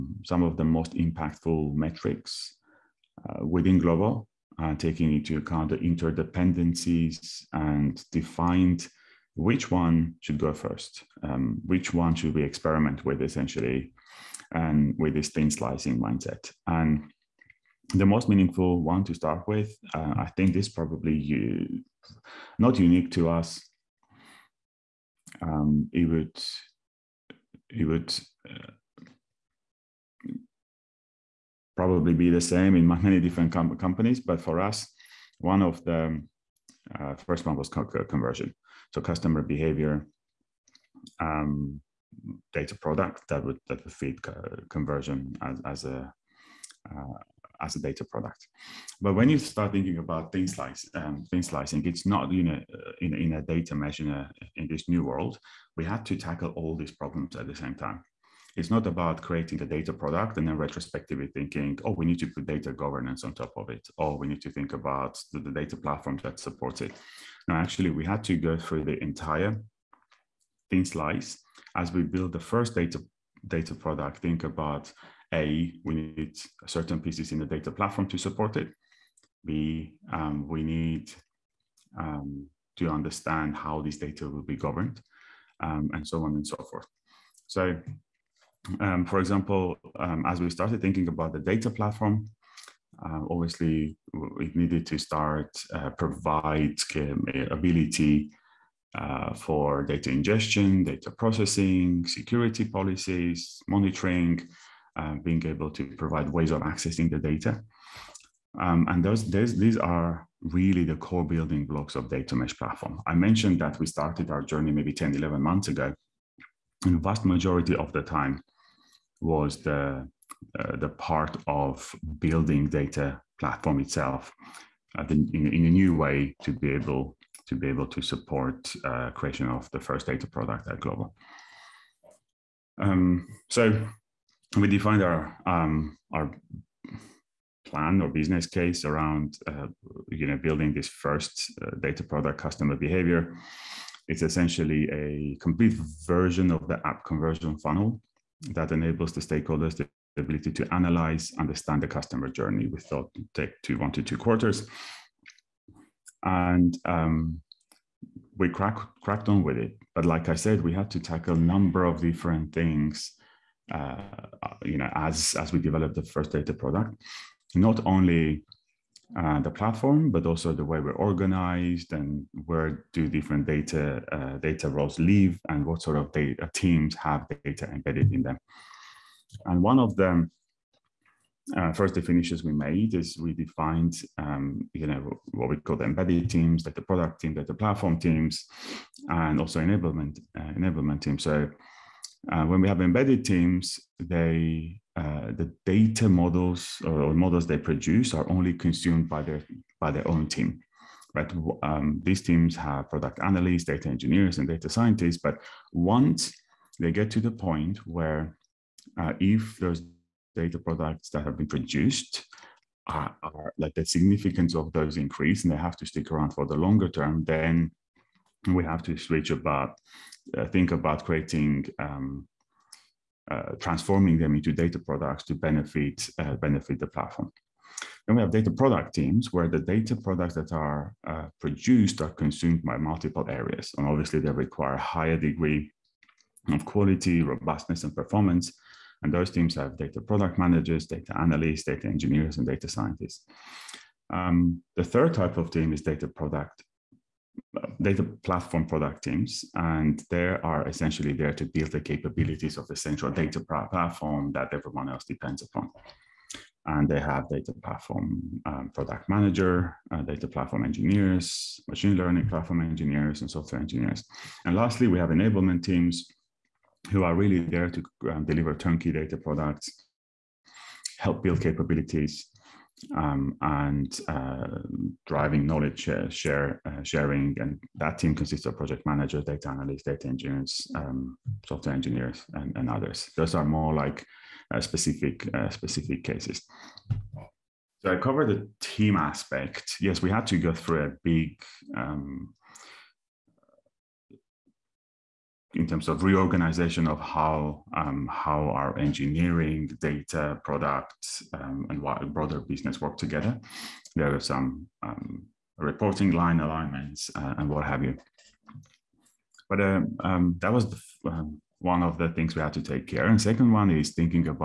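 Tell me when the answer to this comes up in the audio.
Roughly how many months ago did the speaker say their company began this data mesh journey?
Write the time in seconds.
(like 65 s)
114 s.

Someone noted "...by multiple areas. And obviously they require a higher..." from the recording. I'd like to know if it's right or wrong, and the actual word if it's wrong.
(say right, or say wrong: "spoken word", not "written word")
right.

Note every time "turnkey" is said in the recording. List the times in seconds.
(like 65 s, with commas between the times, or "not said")
268 s.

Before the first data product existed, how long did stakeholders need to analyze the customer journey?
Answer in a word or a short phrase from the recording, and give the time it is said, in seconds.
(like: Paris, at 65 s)
One to two quarters, at 153 s.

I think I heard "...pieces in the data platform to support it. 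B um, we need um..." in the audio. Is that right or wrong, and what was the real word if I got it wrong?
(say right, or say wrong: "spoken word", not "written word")
right.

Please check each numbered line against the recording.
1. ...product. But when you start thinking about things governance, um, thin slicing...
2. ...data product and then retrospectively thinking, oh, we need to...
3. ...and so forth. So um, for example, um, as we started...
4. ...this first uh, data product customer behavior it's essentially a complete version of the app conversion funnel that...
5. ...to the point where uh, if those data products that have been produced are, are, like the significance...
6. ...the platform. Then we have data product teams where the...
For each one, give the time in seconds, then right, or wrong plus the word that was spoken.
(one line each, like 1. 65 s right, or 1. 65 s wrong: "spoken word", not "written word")
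1. 48 s wrong: "slice", not "governance"
2. 59 s right
3. 86 s right
4. 140 s right
5. 207 s right
6. 226 s right.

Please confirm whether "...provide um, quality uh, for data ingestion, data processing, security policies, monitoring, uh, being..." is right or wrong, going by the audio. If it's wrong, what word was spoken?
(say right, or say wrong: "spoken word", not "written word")
wrong: "ability", not "quality".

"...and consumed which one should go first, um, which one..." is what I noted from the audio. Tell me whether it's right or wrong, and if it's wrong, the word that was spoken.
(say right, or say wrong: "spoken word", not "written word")
wrong: "defined", not "consumed".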